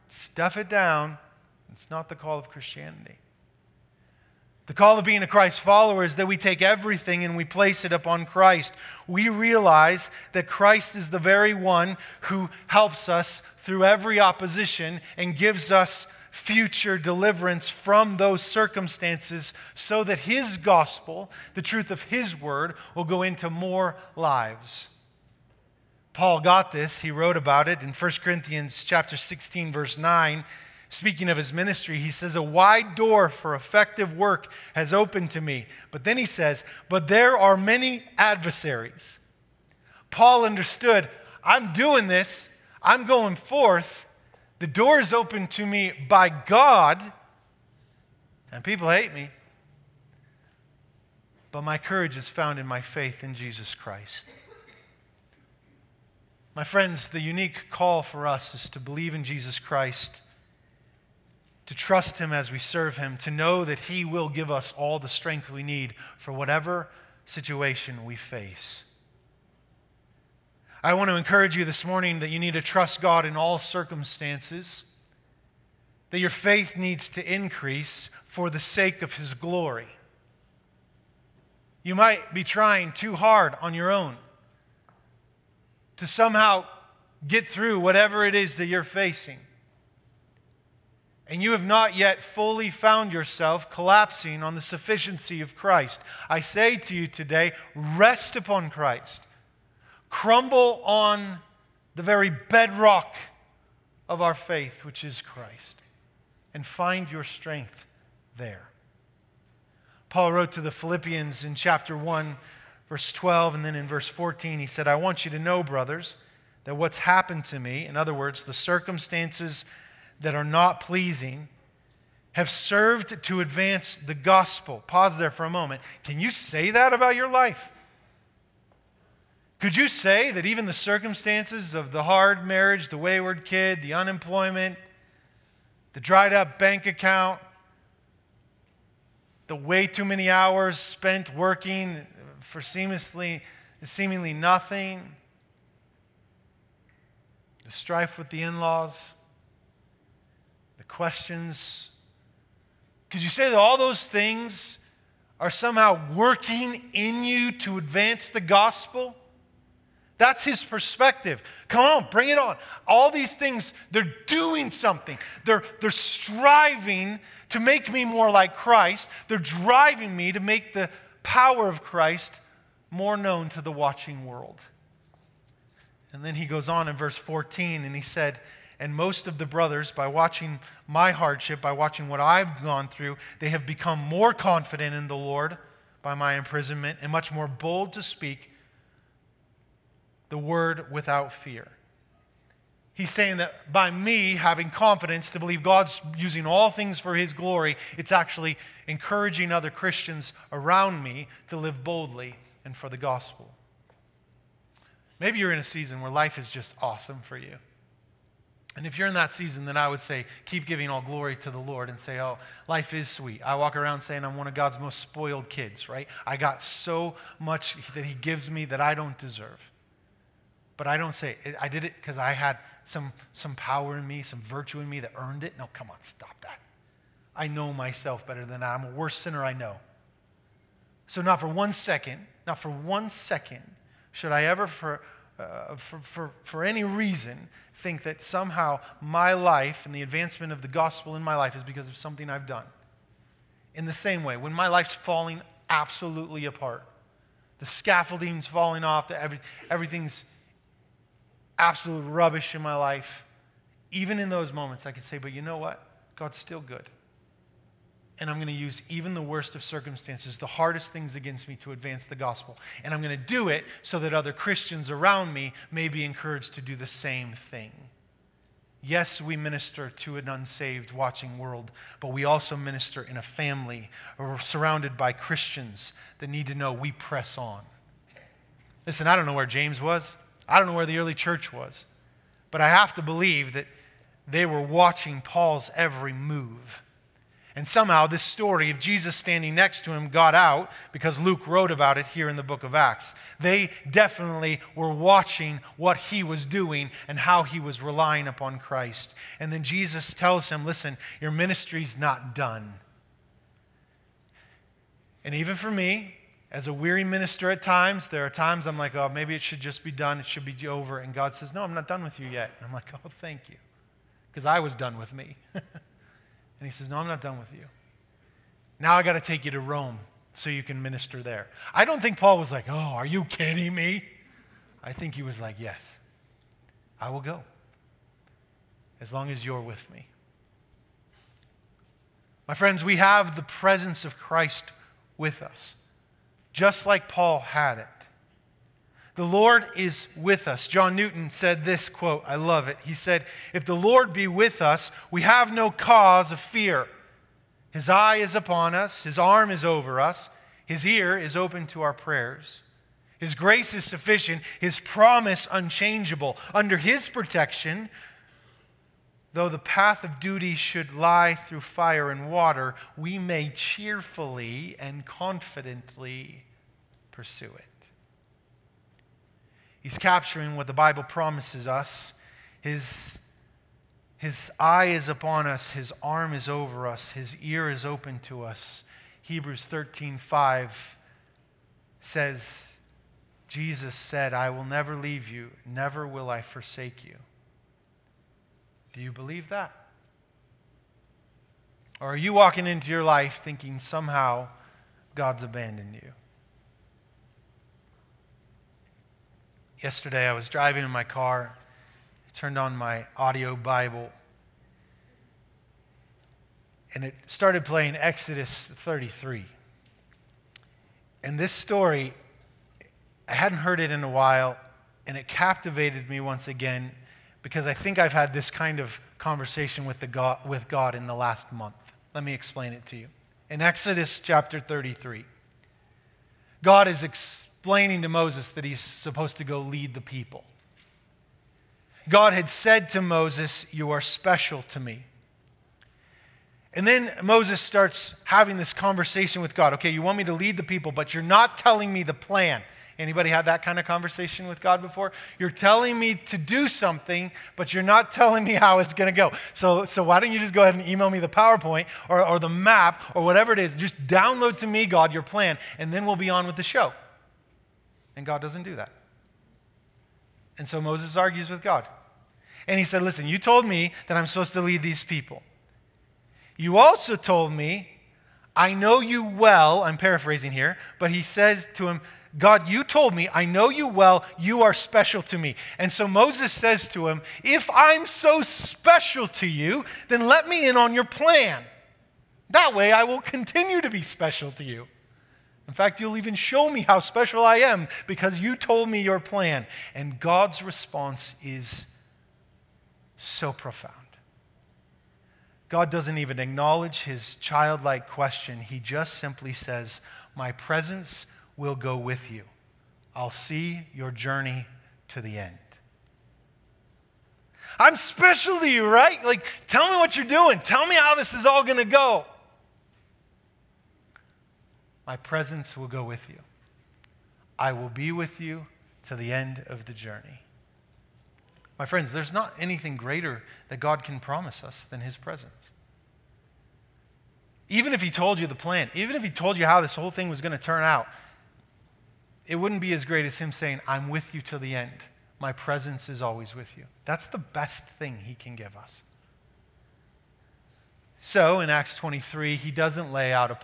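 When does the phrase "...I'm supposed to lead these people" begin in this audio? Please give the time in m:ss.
7:44.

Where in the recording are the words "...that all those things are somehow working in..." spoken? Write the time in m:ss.
2:33.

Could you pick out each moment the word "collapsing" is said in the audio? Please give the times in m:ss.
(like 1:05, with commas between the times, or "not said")
1:33.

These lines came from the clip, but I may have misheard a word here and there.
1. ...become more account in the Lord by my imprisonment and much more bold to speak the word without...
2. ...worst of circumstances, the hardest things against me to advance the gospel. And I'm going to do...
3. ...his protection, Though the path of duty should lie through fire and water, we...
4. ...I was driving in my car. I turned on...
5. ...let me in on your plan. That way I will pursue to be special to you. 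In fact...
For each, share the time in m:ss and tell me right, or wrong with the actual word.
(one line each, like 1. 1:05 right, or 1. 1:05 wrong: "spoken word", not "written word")
1. 3:03 wrong: "confident", not "account"
2. 4:19 right
3. 5:56 right
4. 6:40 right
5. 8:00 wrong: "continue", not "pursue".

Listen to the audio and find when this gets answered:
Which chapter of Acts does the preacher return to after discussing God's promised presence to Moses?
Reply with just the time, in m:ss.
9:01.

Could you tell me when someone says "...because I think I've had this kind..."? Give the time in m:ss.
6:57.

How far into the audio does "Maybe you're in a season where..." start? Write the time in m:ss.
3:25.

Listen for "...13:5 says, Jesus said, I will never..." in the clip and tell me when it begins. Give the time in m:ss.
6:19.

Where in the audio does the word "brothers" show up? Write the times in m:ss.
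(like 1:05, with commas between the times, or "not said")
1:55, 2:59.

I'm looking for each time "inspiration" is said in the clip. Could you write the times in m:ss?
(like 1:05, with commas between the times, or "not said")
not said.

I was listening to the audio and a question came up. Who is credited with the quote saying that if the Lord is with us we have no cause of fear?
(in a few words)
John Newton.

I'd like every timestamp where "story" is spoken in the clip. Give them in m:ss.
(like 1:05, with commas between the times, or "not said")
4:48, 6:51.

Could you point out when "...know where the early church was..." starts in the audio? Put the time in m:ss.
4:40.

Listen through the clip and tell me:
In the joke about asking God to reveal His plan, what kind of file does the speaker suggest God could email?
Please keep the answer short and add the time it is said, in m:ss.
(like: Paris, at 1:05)
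PowerPoint, at 7:31.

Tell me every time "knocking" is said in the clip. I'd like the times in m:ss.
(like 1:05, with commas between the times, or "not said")
not said.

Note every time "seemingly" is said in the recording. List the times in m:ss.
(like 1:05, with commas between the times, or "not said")
2:23.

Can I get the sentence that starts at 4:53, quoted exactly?
They definitely were watching what he was doing and how he was relying upon Christ.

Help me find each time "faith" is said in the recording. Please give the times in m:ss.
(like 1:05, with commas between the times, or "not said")
0:52, 1:16, 1:44.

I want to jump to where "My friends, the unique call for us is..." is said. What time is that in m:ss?
0:56.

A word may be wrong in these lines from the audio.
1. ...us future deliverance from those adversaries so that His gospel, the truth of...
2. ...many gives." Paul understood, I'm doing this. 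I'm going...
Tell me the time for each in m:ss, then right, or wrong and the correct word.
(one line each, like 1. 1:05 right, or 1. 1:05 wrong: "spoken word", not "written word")
1. 0:15 wrong: "circumstances", not "adversaries"
2. 0:37 wrong: "adversaries", not "gives".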